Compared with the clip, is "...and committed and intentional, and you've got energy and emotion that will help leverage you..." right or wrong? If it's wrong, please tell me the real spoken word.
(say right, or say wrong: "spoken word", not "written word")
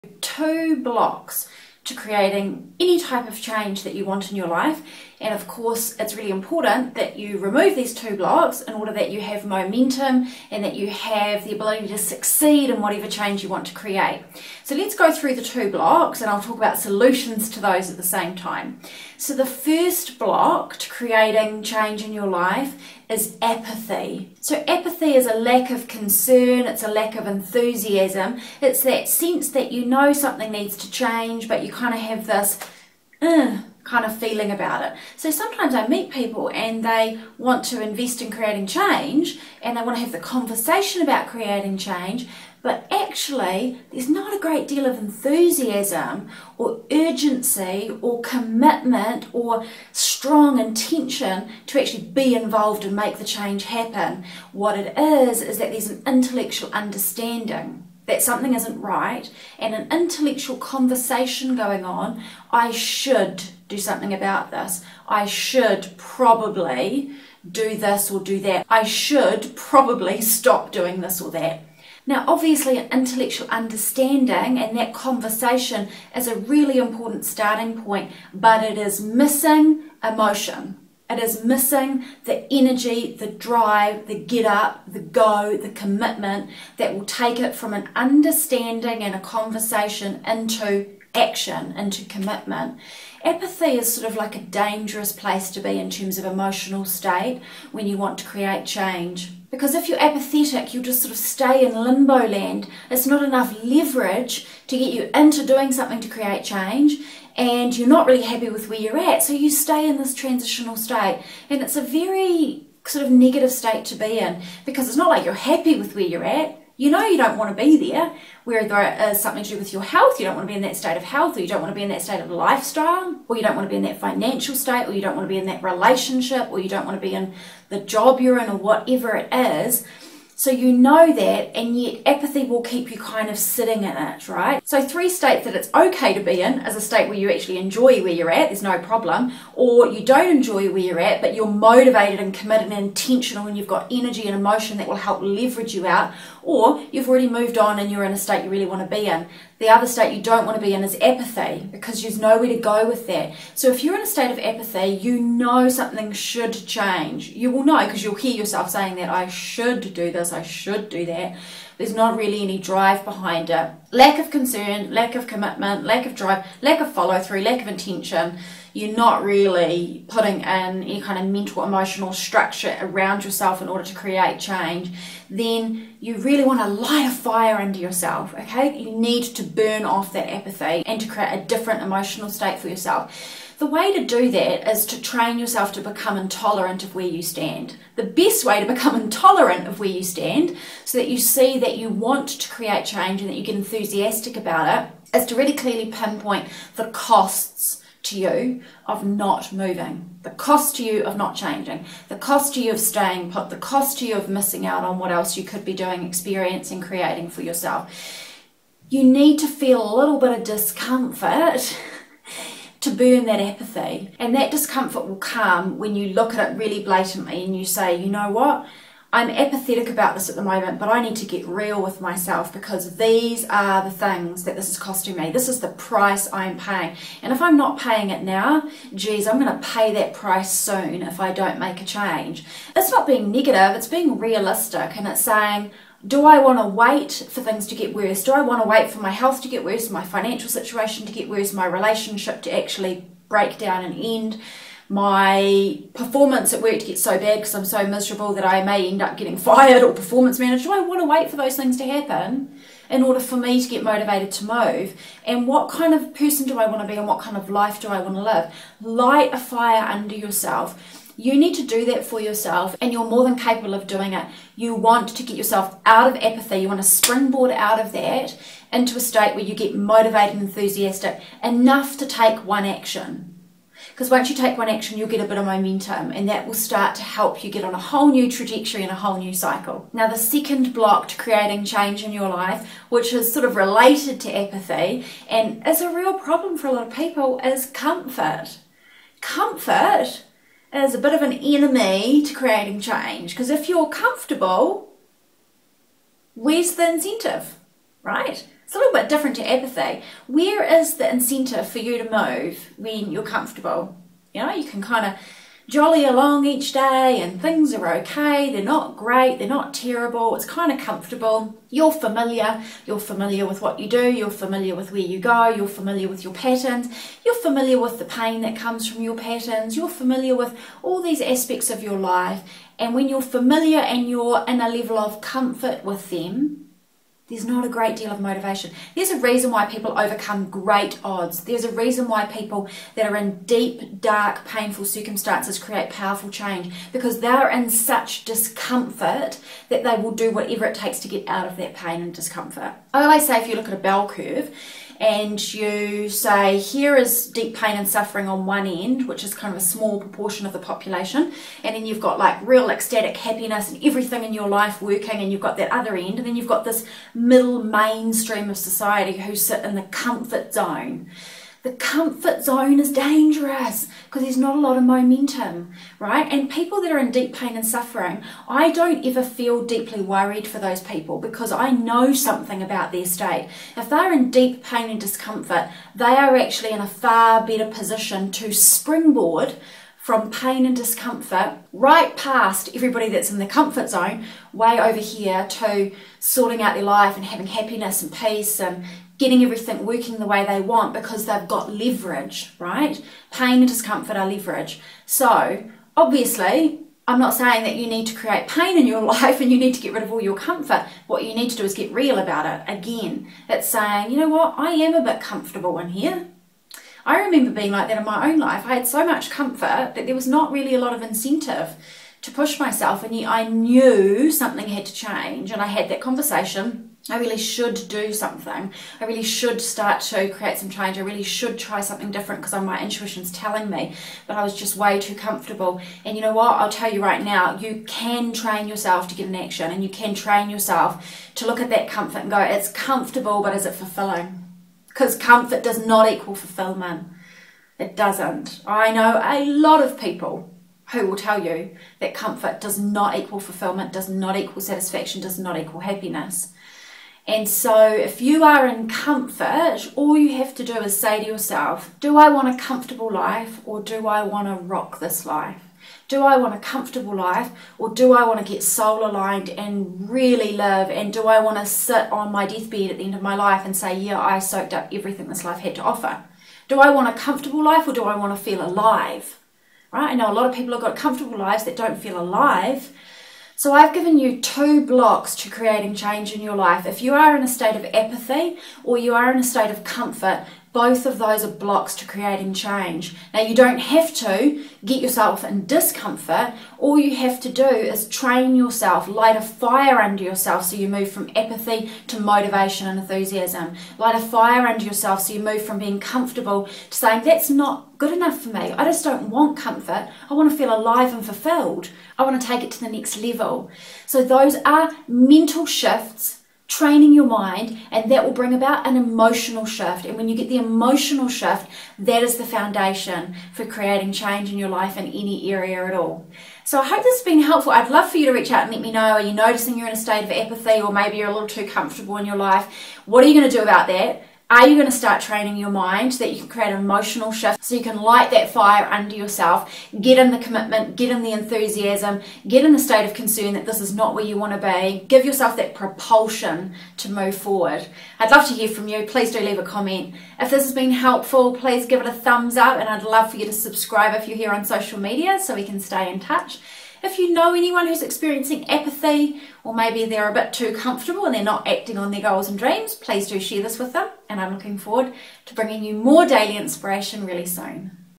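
right.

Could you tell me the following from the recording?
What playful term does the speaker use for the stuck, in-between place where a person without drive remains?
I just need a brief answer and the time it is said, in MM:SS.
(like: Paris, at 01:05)
Limbo land, at 01:41.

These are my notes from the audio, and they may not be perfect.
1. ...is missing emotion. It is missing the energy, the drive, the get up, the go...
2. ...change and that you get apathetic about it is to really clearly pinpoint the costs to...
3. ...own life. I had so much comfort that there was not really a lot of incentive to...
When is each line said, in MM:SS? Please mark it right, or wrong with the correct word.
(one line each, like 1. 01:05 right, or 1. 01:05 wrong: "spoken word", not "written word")
1. 01:18 right
2. 03:12 wrong: "enthusiastic", not "apathetic"
3. 06:48 right.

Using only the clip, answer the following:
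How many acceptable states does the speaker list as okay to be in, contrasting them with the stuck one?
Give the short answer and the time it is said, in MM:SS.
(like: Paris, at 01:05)
3, at 02:14.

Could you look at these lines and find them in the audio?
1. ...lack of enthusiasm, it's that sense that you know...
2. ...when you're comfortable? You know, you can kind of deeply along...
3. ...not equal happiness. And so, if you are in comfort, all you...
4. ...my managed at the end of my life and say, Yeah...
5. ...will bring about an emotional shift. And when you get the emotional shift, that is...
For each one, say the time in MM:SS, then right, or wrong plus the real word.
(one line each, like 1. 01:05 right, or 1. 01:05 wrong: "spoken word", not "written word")
1. 00:26 right
2. 05:02 wrong: "jolly", not "deeply"
3. 07:25 right
4. 07:42 wrong: "deathbed", not "managed"
5. 08:28 right.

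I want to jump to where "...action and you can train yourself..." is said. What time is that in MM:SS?
07:09.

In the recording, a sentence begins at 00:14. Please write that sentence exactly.
So let's go through the two blocks and I'll talk about solutions to those at the same time.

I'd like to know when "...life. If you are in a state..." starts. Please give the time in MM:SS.
07:56.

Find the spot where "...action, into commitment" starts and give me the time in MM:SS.
01:31.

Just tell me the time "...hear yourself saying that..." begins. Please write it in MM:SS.
02:38.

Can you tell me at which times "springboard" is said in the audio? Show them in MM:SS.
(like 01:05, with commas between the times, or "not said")
04:26, 06:18.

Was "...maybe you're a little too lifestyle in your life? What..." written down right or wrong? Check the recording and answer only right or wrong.
wrong.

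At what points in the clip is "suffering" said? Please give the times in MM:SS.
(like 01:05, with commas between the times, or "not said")
05:47, 06:07.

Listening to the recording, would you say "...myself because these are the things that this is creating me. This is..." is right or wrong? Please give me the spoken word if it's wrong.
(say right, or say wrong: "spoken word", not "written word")
wrong: "costing", not "creating".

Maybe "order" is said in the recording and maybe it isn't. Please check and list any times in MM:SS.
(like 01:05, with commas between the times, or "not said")
00:08, 02:53, 04:13.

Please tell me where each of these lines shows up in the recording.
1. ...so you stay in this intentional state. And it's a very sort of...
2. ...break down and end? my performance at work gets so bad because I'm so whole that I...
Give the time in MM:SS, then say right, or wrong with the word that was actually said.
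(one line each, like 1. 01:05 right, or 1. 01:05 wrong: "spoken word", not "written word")
1. 01:49 wrong: "transitional", not "intentional"
2. 04:03 wrong: "miserable", not "whole".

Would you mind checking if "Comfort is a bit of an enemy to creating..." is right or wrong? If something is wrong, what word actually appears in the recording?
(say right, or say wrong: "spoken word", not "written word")
right.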